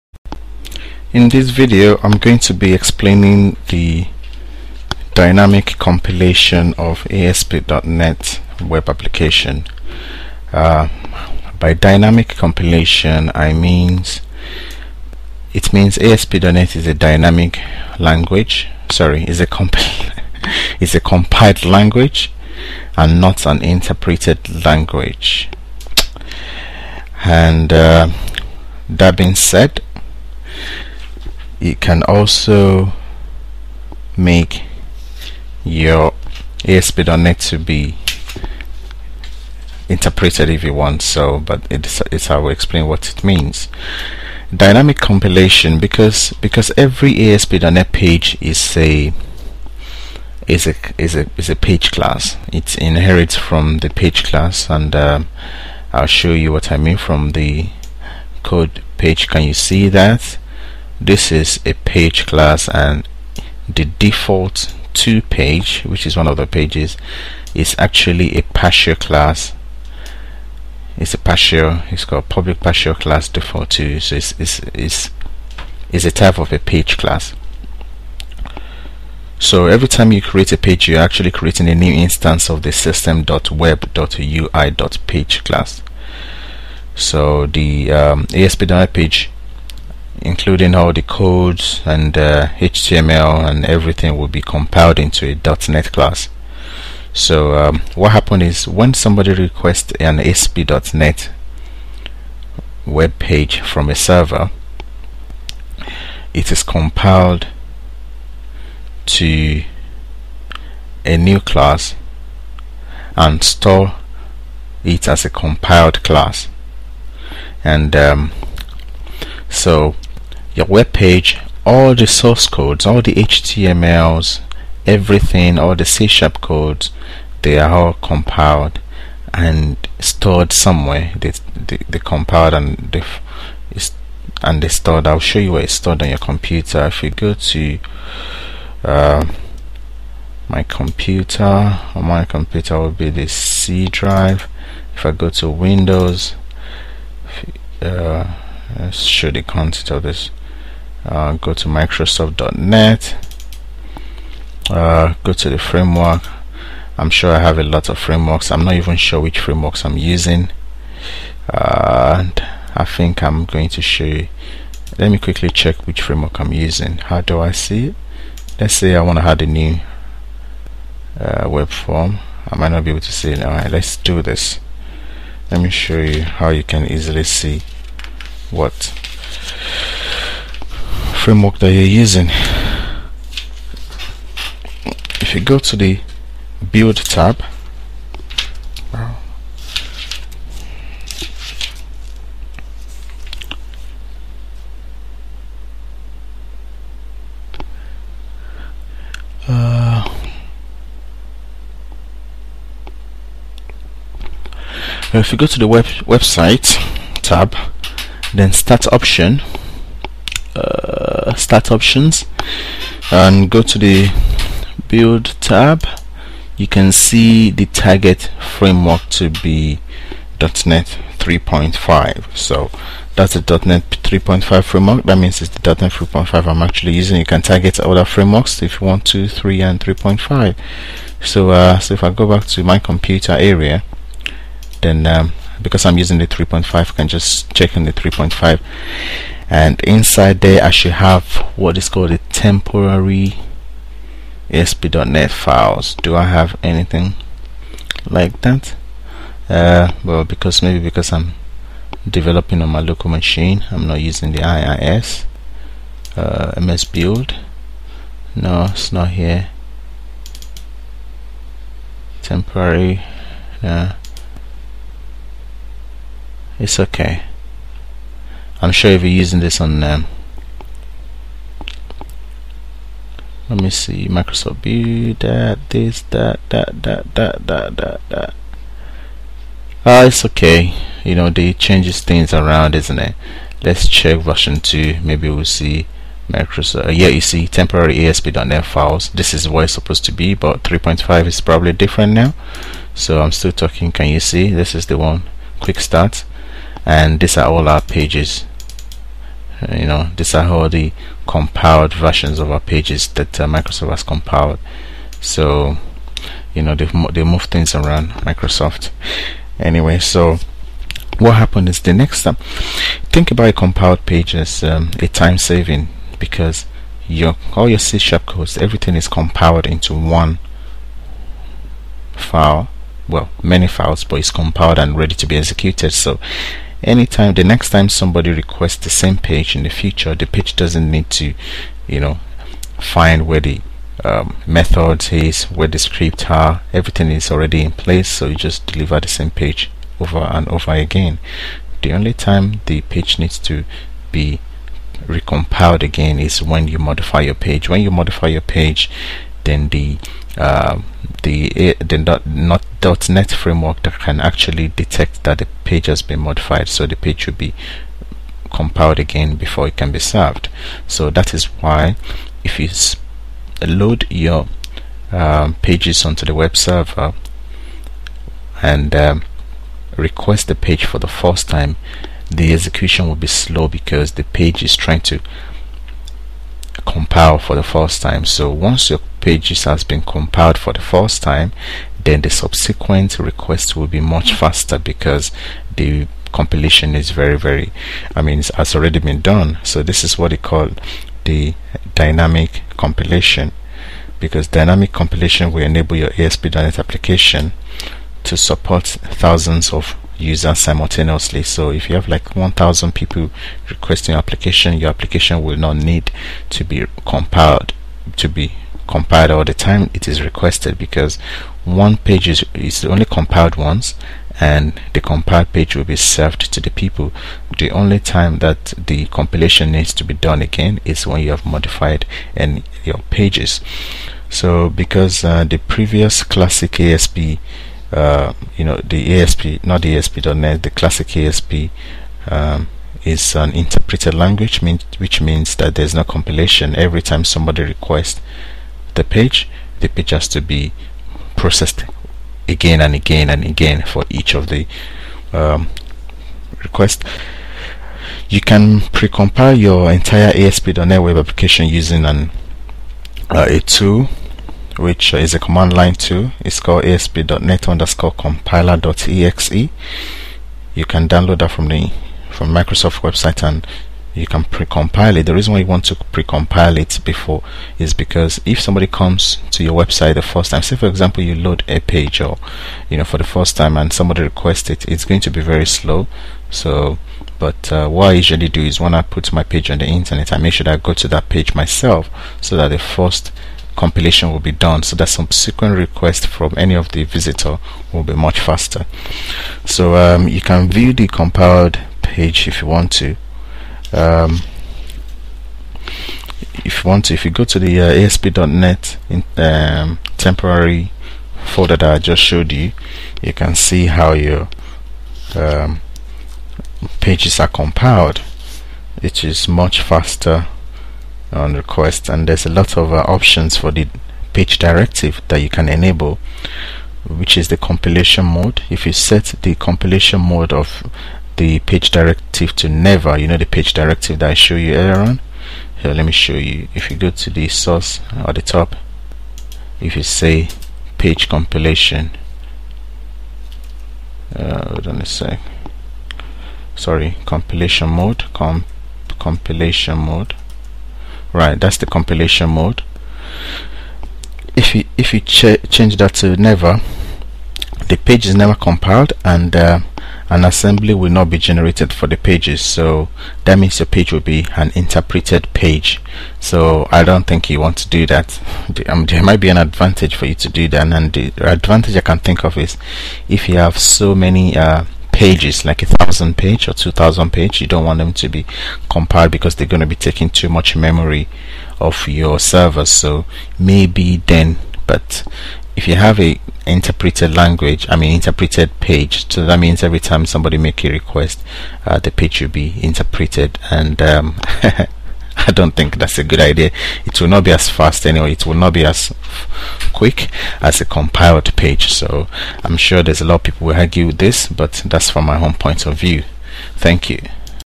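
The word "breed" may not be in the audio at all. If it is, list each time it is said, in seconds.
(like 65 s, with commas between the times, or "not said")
not said.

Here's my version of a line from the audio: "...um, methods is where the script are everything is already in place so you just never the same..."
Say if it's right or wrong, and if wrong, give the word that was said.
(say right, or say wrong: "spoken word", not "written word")
wrong: "deliver", not "never".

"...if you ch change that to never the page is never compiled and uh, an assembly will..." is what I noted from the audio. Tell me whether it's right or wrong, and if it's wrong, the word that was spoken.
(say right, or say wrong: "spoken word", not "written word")
right.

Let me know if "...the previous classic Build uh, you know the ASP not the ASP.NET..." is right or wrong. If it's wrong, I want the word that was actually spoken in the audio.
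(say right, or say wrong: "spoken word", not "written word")
wrong: "ASP", not "Build".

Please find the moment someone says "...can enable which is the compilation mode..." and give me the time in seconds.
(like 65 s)
515 s.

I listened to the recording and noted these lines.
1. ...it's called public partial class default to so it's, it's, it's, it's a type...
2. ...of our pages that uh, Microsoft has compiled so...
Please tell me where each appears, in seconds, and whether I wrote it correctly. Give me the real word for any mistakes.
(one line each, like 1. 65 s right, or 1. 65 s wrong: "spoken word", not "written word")
1. 71 s right
2. 302 s right.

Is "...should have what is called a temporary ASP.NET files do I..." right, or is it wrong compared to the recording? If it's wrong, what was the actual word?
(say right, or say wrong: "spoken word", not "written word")
right.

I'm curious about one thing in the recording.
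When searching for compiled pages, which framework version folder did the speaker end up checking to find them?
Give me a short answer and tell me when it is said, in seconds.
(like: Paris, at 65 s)
version 2, at 284 s.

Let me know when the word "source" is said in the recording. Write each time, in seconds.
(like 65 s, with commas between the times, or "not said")
122 s, 527 s.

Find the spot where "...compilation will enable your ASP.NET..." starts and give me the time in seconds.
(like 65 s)
394 s.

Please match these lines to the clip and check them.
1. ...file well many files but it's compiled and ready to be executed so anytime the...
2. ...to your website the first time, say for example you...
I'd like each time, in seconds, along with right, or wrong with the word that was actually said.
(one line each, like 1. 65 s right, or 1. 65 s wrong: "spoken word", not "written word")
1. 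322 s right
2. 469 s right.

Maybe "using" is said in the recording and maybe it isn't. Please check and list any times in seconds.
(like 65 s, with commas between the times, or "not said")
159 s, 166 s, 181 s, 226 s, 235 s, 253 s, 269 s, 451 s.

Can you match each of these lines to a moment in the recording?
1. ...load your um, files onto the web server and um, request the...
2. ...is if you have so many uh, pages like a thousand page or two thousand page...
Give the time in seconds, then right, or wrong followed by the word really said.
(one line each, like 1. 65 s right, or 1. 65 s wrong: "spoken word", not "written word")
1. 363 s wrong: "pages", not "files"
2. 562 s right.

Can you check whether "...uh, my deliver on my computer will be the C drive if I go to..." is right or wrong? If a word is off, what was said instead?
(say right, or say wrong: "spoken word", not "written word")
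wrong: "computer", not "deliver".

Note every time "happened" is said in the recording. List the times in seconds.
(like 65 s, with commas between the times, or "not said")
98 s, 311 s.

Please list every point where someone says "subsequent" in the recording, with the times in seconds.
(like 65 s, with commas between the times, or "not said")
382 s, 485 s.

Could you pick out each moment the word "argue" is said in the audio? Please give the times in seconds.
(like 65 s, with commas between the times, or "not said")
593 s.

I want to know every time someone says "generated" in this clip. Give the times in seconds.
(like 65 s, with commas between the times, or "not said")
551 s.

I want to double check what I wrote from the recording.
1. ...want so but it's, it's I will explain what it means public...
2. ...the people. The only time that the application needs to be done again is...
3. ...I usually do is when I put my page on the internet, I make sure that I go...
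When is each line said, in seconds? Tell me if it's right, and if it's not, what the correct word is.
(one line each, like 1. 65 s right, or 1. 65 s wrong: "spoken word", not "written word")
1. 40 s wrong: "dynamic", not "public"
2. 416 s wrong: "compilation", not "application"
3. 478 s right.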